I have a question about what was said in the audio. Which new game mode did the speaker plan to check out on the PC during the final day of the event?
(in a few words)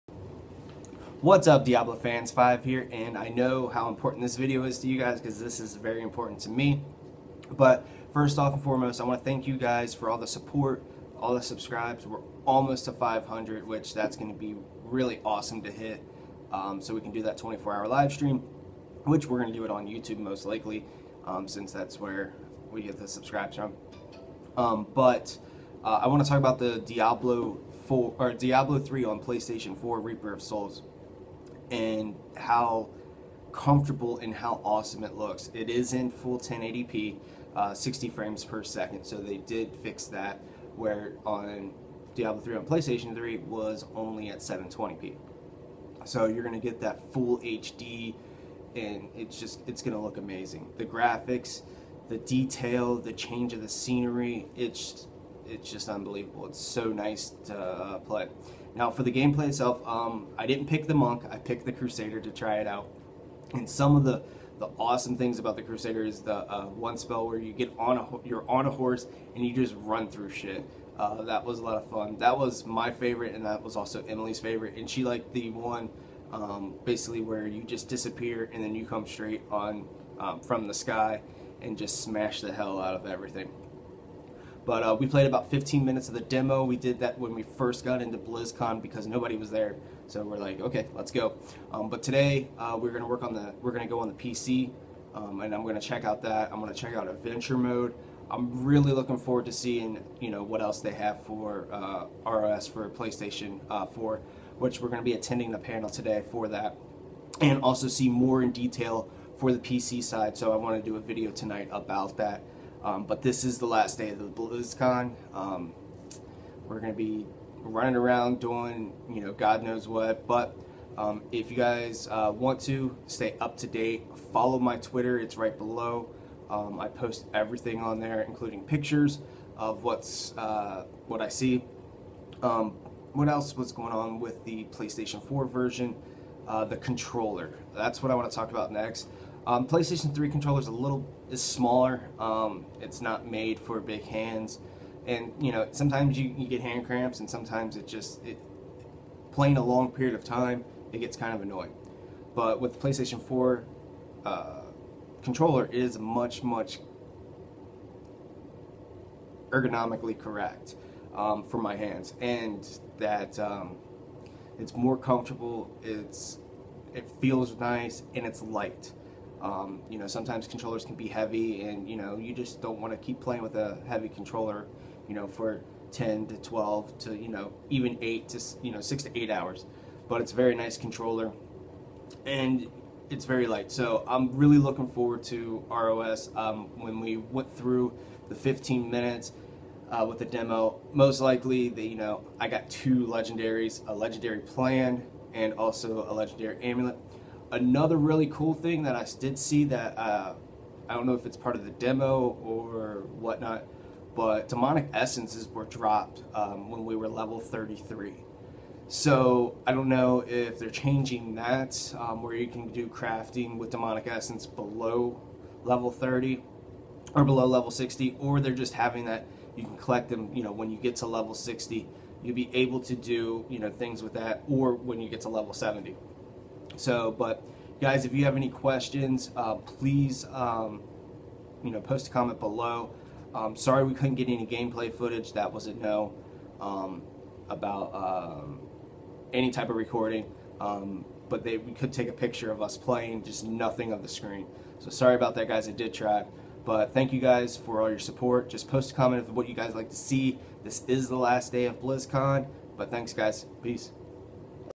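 Adventure Mode.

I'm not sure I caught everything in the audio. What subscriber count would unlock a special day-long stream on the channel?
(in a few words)
500.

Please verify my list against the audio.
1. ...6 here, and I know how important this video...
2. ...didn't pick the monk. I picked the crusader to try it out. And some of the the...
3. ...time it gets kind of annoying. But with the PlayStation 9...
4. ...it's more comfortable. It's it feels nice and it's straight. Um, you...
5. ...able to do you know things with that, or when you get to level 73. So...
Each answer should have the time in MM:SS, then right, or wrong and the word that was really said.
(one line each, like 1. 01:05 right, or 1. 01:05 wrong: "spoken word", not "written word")
1. 00:02 wrong: "5", not "6"
2. 01:00 right
3. 02:30 wrong: "4", not "9"
4. 02:44 wrong: "light", not "straight"
5. 03:42 wrong: "70", not "73".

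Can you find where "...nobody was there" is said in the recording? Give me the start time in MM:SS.
01:29.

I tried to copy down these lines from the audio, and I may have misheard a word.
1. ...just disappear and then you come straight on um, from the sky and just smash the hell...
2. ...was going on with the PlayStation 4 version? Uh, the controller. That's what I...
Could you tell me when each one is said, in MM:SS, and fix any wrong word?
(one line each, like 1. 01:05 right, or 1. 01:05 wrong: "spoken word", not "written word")
1. 01:17 right
2. 02:13 right.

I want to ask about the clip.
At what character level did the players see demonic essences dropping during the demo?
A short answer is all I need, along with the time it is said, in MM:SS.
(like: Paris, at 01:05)
33, at 03:27.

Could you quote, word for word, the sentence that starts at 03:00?
But it's a very nice controller, and it's very light.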